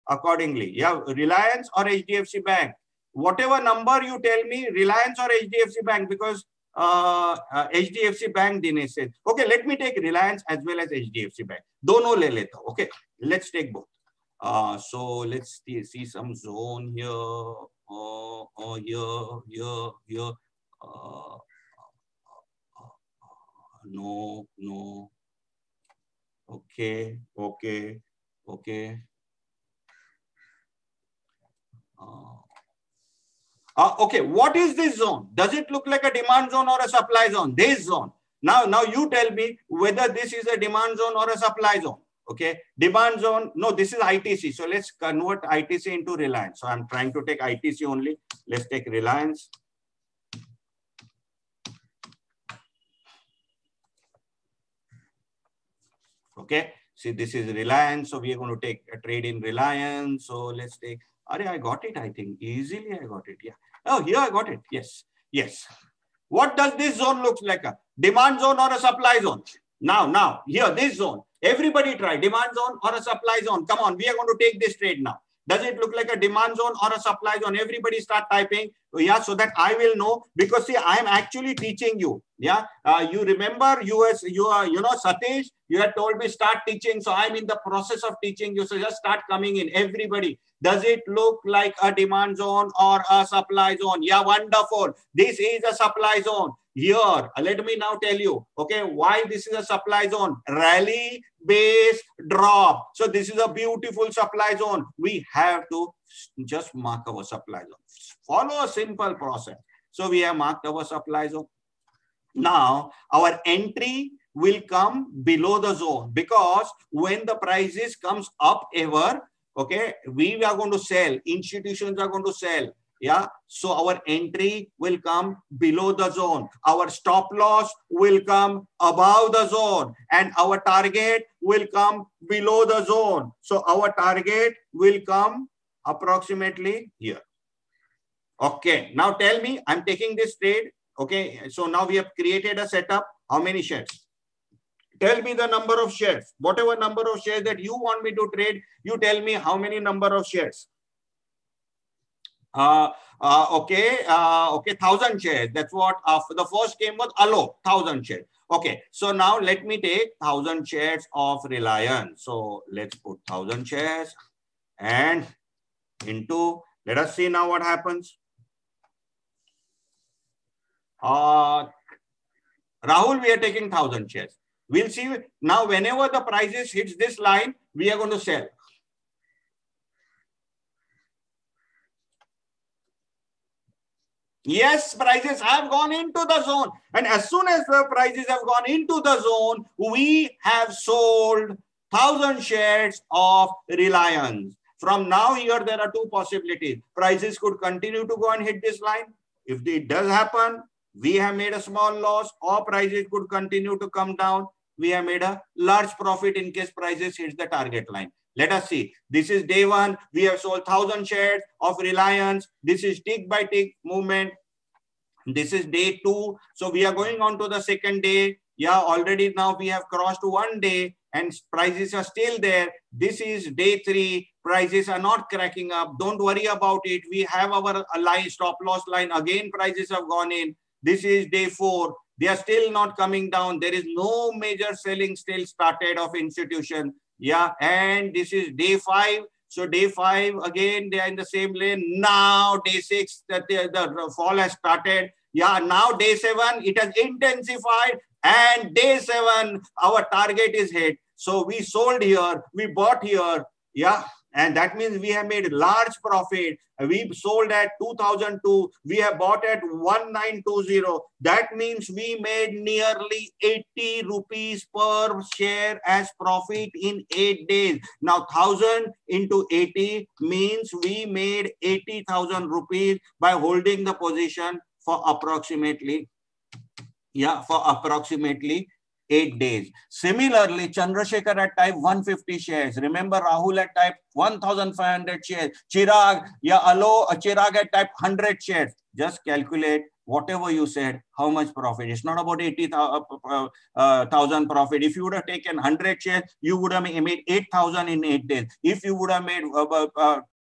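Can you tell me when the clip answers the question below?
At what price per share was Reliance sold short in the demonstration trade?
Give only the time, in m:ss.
4:16.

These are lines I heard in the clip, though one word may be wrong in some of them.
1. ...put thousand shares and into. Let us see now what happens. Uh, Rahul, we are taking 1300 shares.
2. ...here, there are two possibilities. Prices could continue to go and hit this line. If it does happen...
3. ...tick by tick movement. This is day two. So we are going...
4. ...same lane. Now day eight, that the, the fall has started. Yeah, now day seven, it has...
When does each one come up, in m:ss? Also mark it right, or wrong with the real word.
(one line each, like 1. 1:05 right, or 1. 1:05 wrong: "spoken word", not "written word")
1. 2:42 wrong: "1000", not "1300"
2. 3:15 right
3. 3:33 right
4. 4:01 wrong: "six", not "eight".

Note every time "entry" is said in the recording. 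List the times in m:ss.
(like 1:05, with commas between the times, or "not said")
1:53, 2:04.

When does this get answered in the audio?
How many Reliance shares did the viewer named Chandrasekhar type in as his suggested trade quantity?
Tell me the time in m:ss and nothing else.
4:40.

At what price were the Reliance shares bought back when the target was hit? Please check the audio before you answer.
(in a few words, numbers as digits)
1920.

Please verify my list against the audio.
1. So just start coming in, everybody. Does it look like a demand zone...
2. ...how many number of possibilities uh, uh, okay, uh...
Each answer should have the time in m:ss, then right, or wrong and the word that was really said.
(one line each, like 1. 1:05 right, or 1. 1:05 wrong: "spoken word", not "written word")
1. 1:28 right
2. 2:29 wrong: "shares", not "possibilities".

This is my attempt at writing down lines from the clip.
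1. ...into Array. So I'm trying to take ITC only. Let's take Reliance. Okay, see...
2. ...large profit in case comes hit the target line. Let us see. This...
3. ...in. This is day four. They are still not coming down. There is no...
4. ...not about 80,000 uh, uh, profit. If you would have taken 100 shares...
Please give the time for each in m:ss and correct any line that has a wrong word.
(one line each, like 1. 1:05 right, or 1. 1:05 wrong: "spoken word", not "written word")
1. 0:45 wrong: "Reliance", not "Array"
2. 3:25 wrong: "prices", not "comes"
3. 3:50 right
4. 4:52 right.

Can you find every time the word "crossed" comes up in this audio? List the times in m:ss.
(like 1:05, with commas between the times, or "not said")
3:39.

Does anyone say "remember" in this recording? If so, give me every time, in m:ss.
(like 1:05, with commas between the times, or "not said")
1:23, 4:42.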